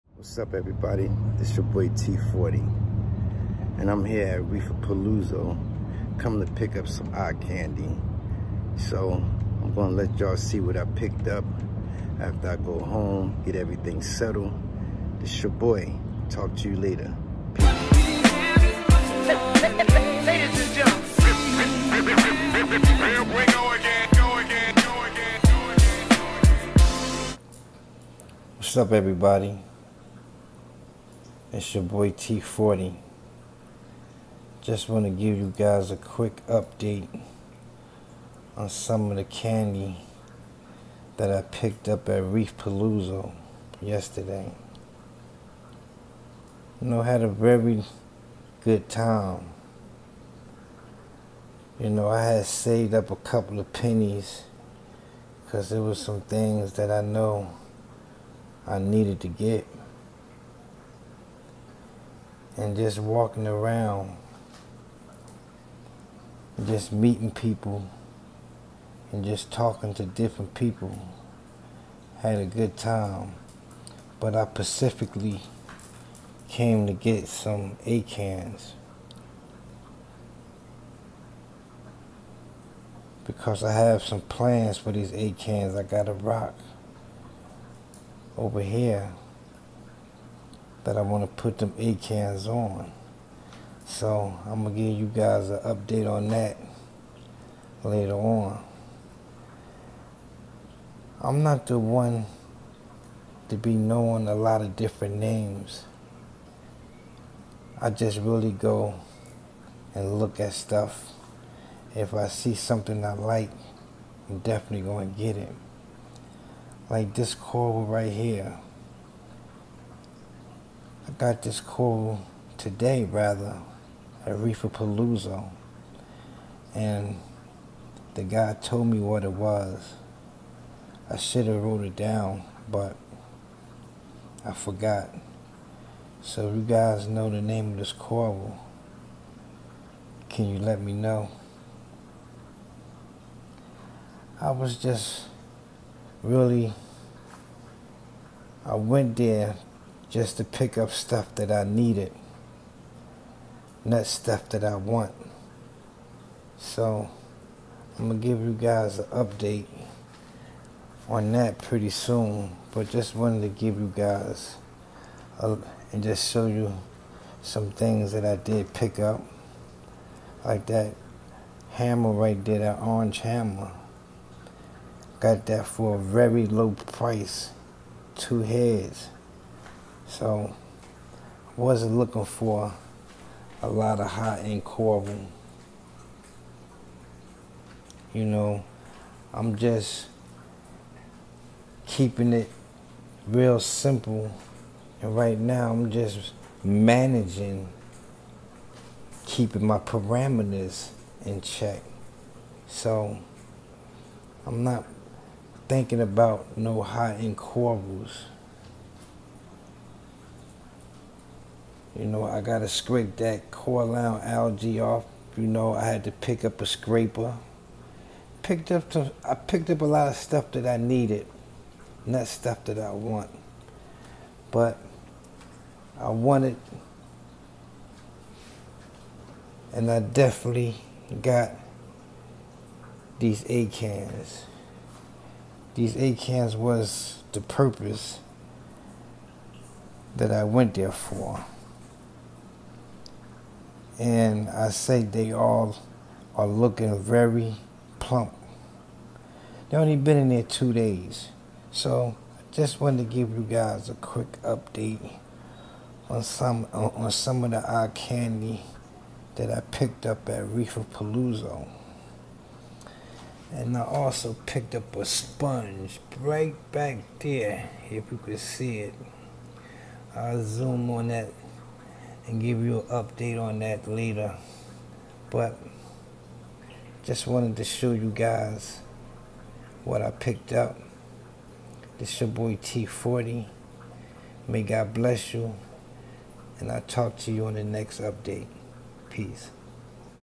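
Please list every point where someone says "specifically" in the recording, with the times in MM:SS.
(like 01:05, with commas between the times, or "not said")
01:14.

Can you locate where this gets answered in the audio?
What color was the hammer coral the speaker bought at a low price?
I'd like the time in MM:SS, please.
02:52.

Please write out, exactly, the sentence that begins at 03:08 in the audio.
You know, I'm just keeping it real simple.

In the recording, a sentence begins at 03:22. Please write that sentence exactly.
So I'm not thinking about no high-end corals.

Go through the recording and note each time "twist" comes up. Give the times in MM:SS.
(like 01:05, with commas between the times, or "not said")
not said.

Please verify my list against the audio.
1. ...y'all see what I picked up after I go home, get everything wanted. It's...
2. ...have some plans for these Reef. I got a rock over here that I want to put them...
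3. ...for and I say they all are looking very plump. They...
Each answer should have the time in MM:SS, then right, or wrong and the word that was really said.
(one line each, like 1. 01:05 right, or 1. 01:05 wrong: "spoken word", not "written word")
1. 00:10 wrong: "settled", not "wanted"
2. 01:23 wrong: "ACANs", not "Reef"
3. 04:00 right.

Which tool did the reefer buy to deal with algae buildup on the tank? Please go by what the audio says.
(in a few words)
A scraper.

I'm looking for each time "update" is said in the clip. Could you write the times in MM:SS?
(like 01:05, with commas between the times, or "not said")
00:36, 01:35, 02:39, 04:14, 04:32, 04:47.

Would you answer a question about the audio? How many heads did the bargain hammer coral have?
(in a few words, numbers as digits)
2.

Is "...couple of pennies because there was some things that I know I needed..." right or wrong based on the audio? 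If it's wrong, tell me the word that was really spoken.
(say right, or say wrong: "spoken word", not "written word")
right.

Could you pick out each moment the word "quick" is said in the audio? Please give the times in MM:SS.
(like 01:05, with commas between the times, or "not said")
00:35, 04:13.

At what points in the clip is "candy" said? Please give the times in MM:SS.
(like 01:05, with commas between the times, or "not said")
00:07, 00:39, 04:17.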